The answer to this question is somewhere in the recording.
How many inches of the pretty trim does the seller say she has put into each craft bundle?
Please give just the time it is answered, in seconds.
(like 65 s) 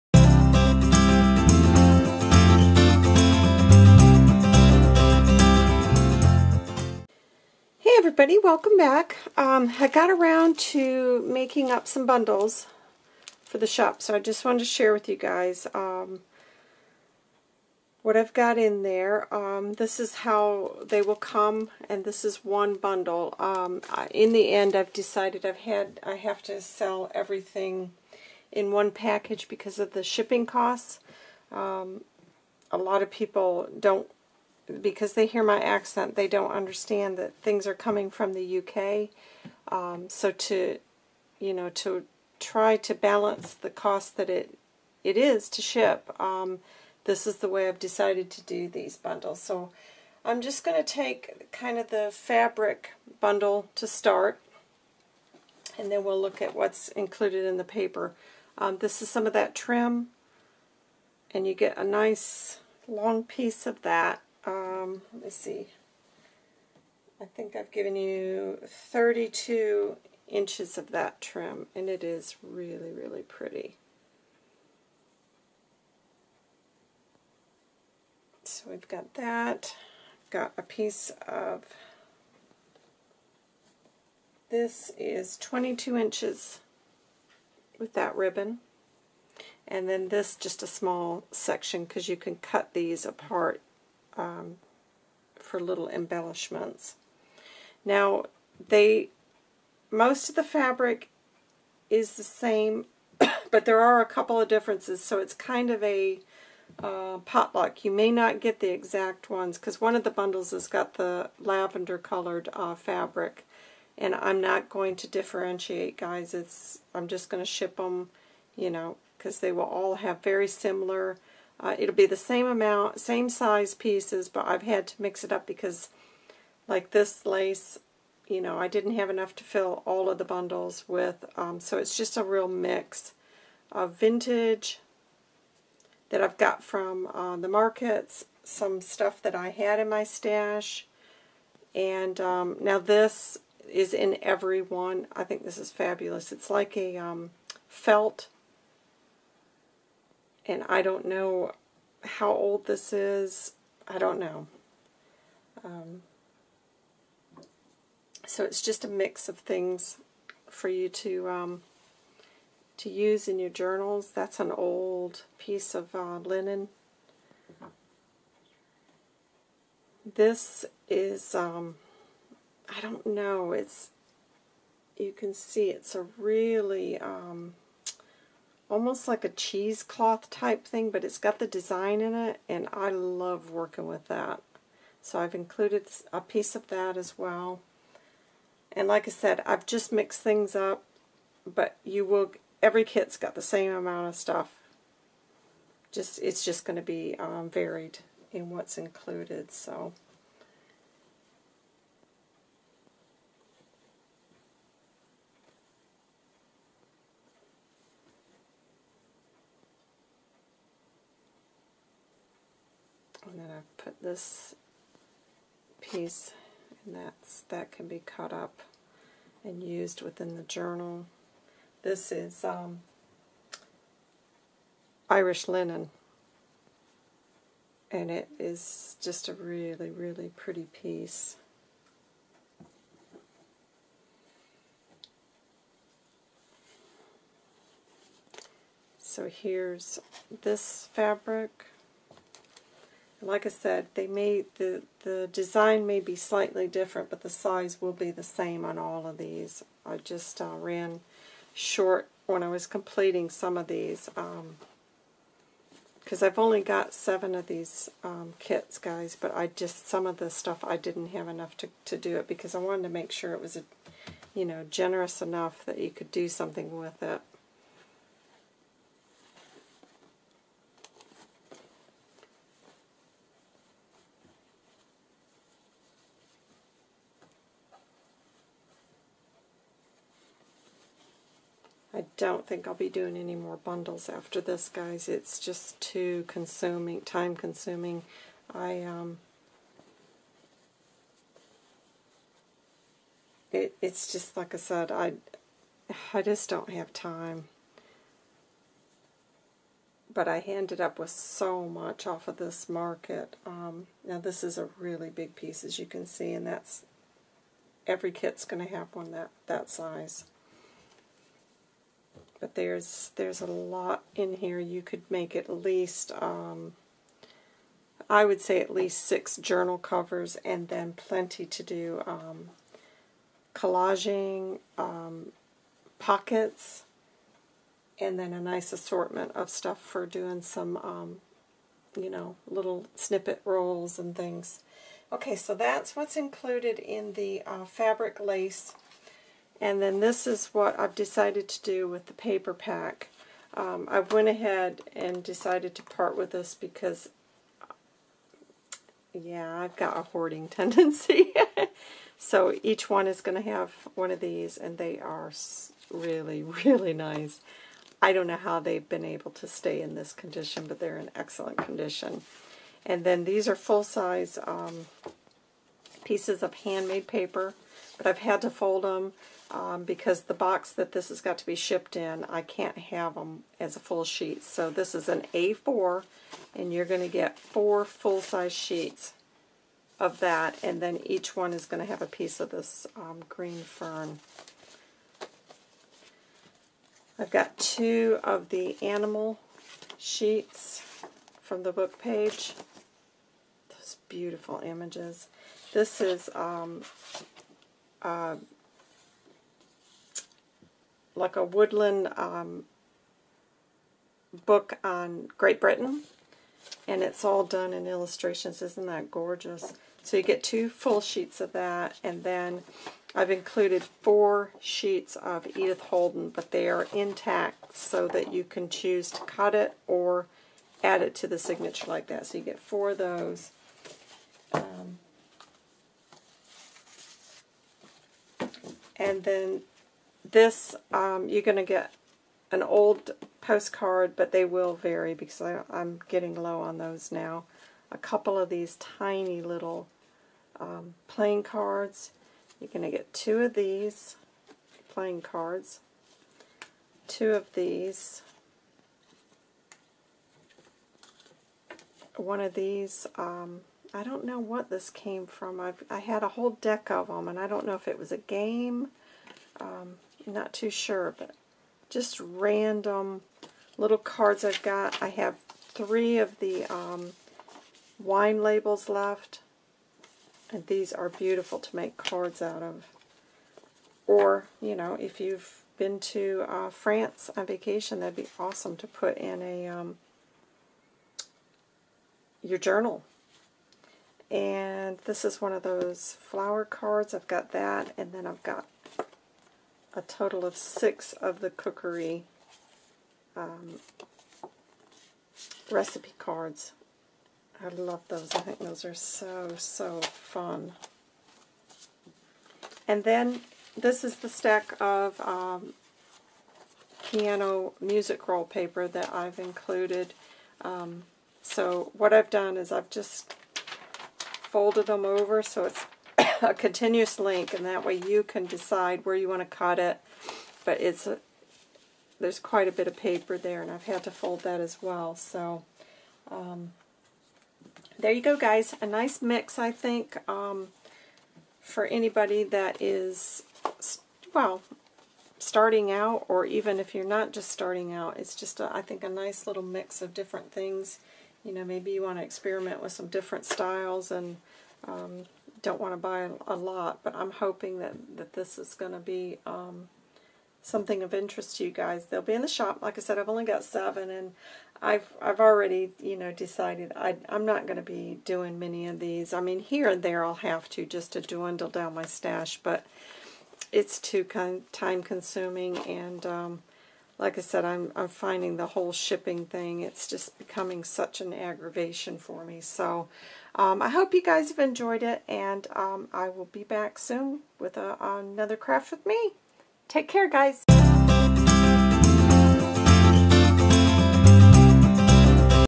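68 s.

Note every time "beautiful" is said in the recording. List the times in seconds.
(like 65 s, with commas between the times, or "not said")
394 s, 471 s.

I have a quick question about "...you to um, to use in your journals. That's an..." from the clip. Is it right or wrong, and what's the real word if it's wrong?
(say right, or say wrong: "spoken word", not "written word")
right.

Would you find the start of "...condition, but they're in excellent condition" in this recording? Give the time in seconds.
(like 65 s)
360 s.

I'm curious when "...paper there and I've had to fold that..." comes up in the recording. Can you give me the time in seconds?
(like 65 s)
522 s.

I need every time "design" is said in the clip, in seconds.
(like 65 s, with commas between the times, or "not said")
181 s, 245 s.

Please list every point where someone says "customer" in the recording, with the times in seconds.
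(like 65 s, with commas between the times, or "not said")
not said.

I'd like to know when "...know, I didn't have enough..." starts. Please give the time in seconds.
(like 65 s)
128 s.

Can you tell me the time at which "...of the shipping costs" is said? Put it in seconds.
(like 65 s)
29 s.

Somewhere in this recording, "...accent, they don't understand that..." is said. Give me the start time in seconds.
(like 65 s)
35 s.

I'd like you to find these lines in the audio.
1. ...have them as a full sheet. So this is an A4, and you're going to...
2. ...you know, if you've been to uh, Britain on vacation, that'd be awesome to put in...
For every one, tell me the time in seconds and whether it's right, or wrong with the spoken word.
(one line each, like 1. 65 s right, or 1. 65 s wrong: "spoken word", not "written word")
1. 372 s right
2. 474 s wrong: "France", not "Britain".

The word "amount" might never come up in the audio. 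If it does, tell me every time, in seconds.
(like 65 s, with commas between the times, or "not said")
122 s, 193 s.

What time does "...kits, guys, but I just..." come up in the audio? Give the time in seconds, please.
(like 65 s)
258 s.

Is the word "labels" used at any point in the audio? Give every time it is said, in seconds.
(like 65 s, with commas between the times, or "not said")
468 s.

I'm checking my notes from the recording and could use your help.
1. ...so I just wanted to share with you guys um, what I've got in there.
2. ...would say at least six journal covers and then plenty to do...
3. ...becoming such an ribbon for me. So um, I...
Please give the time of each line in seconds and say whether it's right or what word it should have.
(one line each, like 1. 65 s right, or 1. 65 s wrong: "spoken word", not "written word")
1. 14 s right
2. 318 s right
3. 570 s wrong: "aggravation", not "ribbon".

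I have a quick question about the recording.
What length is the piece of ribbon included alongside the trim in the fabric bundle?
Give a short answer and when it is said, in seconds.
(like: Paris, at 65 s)
22 inches, at 85 s.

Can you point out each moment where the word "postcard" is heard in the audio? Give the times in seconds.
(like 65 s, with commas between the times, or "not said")
433 s.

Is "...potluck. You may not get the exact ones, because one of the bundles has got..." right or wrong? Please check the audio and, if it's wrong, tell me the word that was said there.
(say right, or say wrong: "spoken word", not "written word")
right.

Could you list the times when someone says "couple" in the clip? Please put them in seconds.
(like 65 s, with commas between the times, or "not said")
104 s, 437 s.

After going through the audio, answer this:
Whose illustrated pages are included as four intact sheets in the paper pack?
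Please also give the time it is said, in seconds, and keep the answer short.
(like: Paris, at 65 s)
Edith Holden, at 415 s.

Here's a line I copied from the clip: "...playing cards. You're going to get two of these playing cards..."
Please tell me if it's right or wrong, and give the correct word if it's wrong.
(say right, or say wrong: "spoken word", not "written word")
right.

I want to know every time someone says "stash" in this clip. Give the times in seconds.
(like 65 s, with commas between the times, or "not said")
140 s, 562 s.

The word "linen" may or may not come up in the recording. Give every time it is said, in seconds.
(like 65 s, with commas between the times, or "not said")
166 s, 225 s.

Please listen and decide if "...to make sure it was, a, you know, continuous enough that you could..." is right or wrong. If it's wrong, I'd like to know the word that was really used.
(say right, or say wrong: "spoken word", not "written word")
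wrong: "generous", not "continuous".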